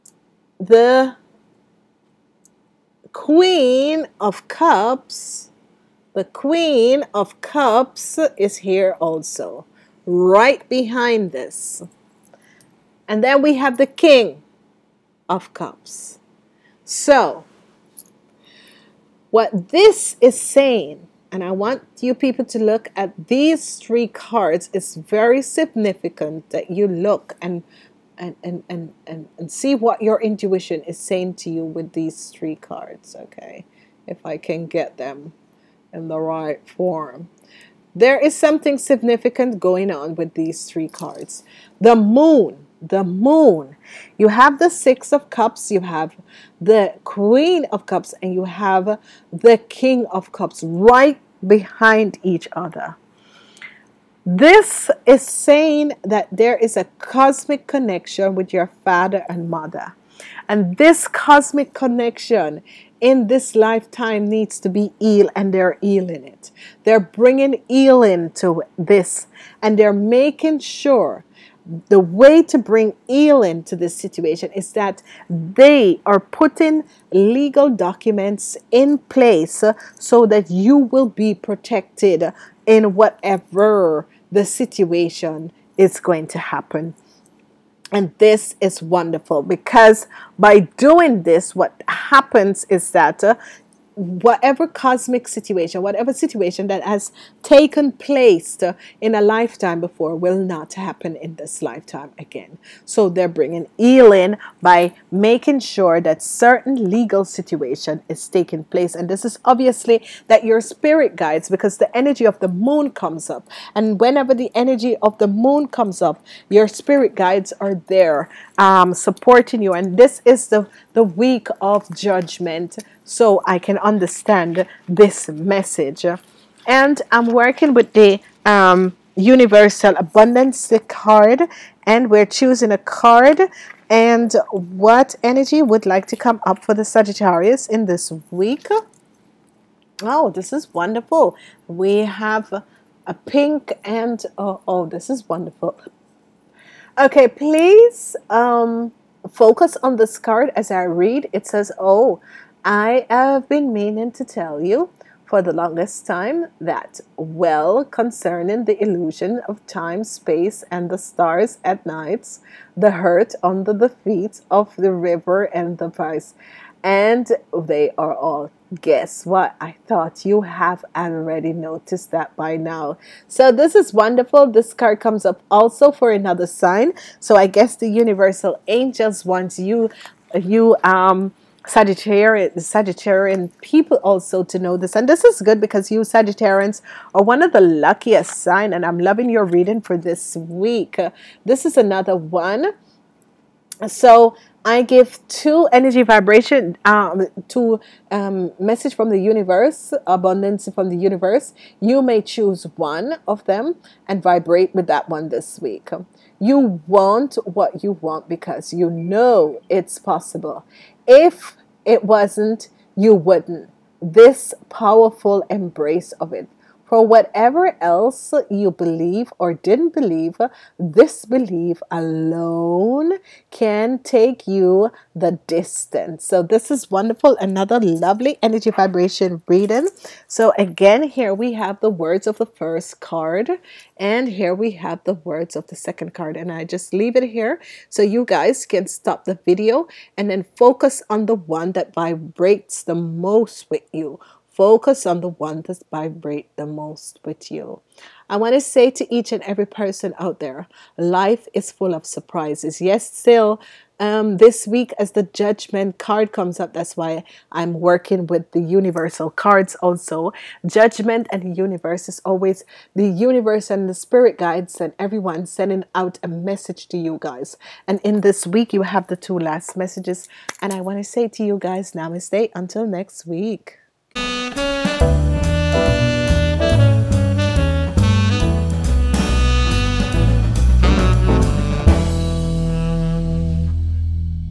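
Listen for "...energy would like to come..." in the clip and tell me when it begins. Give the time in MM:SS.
02:15.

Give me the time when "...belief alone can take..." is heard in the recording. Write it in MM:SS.
03:41.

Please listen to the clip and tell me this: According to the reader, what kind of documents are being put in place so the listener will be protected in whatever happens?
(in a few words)
Legal documents.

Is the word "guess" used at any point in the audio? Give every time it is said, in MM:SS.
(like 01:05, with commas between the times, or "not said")
02:48, 02:57.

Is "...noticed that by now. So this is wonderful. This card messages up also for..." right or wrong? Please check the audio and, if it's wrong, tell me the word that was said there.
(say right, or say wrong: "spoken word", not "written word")
wrong: "comes", not "messages".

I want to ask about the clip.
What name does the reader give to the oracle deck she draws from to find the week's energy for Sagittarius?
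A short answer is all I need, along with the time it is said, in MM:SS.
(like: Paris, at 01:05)
Universal Abundance, at 02:09.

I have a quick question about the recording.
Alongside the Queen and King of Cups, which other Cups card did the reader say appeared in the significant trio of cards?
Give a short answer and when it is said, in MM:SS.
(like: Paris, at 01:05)
Six of Cups, at 00:44.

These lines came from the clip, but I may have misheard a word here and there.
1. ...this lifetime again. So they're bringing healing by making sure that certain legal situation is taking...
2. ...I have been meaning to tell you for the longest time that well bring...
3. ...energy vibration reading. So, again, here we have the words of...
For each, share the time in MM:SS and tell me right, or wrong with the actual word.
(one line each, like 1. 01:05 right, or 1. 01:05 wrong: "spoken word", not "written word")
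1. 01:41 right
2. 02:32 wrong: "concerning", not "bring"
3. 03:48 right.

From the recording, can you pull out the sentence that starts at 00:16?
So, what this is saying and I want you people to look at these three cards.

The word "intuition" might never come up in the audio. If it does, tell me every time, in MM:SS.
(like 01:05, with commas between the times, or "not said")
00:30.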